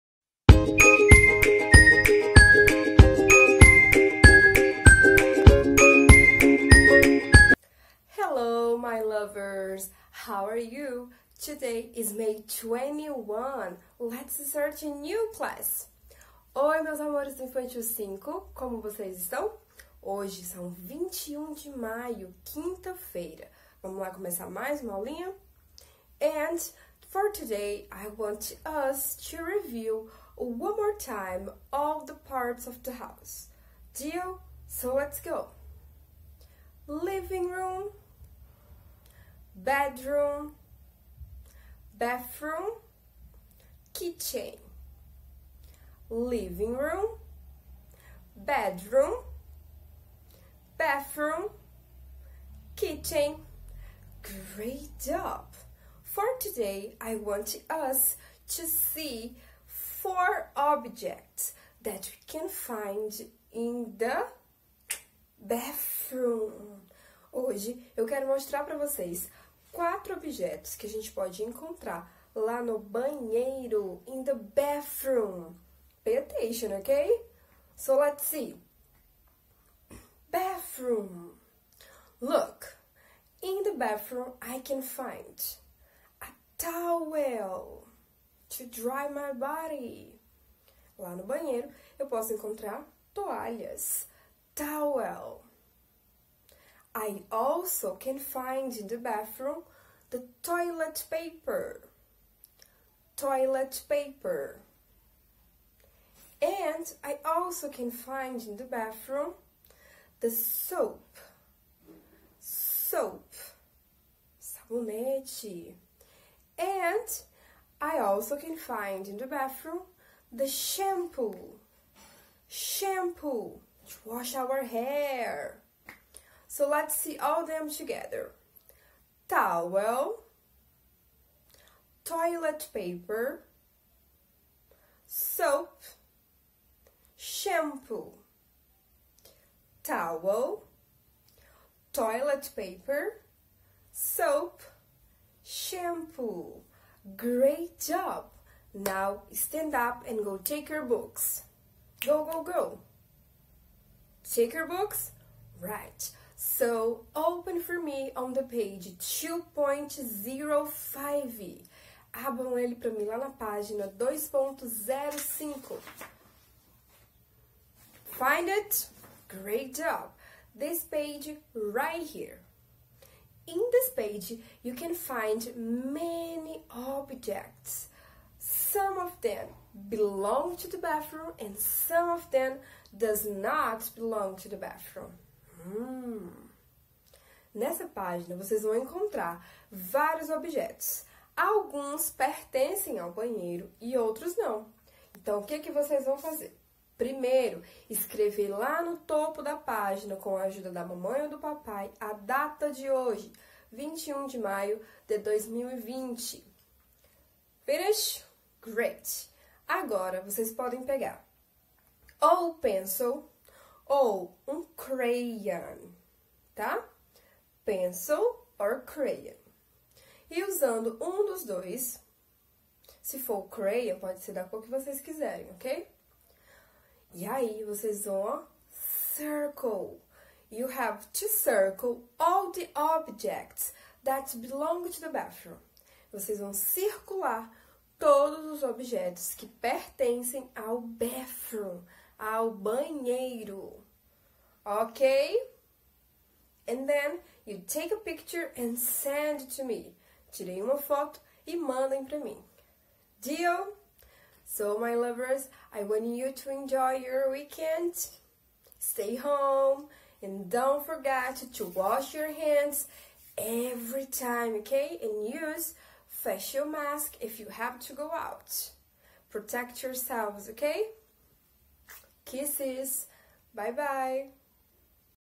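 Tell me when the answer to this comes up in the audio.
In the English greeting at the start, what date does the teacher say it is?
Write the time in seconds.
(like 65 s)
12 s.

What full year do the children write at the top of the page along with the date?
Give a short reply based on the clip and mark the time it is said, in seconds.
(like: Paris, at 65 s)
2020, at 205 s.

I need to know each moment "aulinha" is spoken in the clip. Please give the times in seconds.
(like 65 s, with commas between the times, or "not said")
24 s.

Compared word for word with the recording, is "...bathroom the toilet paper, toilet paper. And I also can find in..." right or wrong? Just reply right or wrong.
right.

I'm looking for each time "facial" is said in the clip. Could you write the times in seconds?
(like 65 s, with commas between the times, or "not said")
266 s.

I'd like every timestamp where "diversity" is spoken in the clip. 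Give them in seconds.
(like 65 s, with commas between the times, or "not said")
not said.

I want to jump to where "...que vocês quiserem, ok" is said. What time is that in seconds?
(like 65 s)
224 s.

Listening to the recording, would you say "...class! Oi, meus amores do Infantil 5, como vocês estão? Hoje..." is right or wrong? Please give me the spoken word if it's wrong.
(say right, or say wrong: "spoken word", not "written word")
right.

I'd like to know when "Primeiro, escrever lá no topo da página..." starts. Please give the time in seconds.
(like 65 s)
196 s.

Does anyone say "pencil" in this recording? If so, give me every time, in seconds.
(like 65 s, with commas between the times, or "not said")
212 s, 217 s.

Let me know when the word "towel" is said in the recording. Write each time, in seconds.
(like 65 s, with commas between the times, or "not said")
86 s, 94 s, 129 s, 139 s.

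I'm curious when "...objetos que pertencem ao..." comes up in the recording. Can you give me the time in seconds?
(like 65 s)
238 s.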